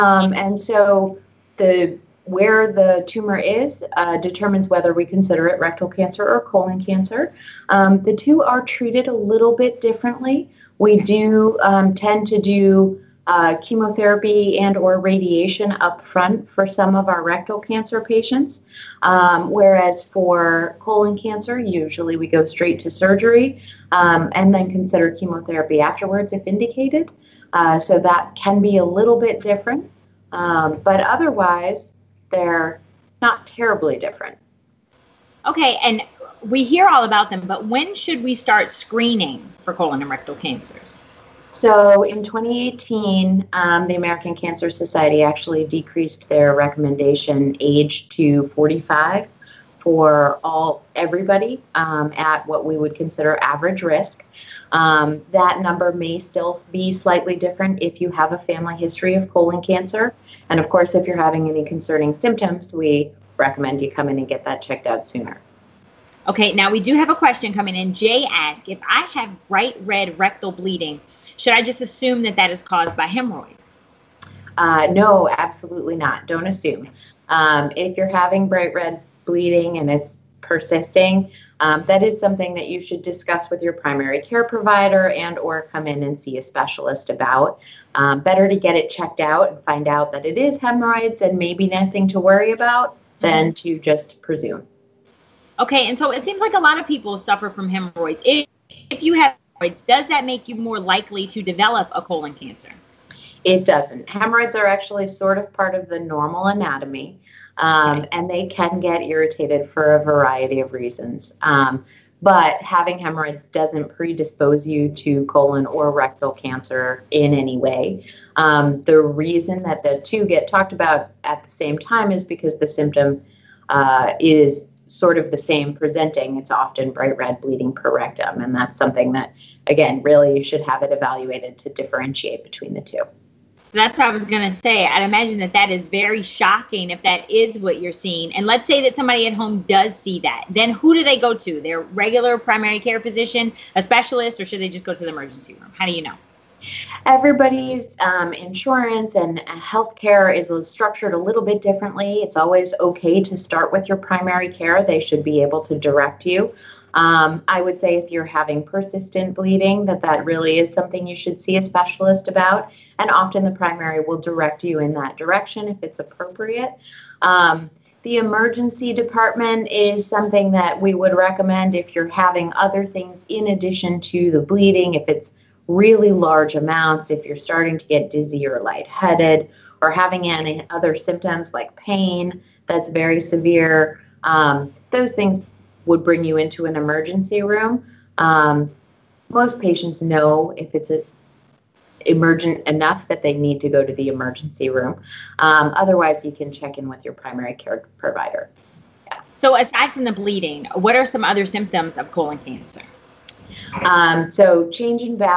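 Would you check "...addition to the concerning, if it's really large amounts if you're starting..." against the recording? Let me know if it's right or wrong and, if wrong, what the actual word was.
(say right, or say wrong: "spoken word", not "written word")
wrong: "bleeding", not "concerning".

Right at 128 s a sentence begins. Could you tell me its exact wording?
And that's something that, again, really you should have it evaluated to differentiate between the two.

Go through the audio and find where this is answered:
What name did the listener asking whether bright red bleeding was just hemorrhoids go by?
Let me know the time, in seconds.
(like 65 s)
67 s.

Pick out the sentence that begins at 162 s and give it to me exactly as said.
And often the primary will direct you in that direction if it's appropriate.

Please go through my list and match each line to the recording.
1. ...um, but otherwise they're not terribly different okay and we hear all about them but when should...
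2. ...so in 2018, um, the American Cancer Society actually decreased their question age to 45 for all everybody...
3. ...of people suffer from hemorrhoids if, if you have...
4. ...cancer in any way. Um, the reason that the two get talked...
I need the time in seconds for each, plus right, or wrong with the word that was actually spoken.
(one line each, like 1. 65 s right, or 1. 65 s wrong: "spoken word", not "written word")
1. 30 s right
2. 41 s wrong: "recommendation", not "question"
3. 96 s right
4. 116 s right.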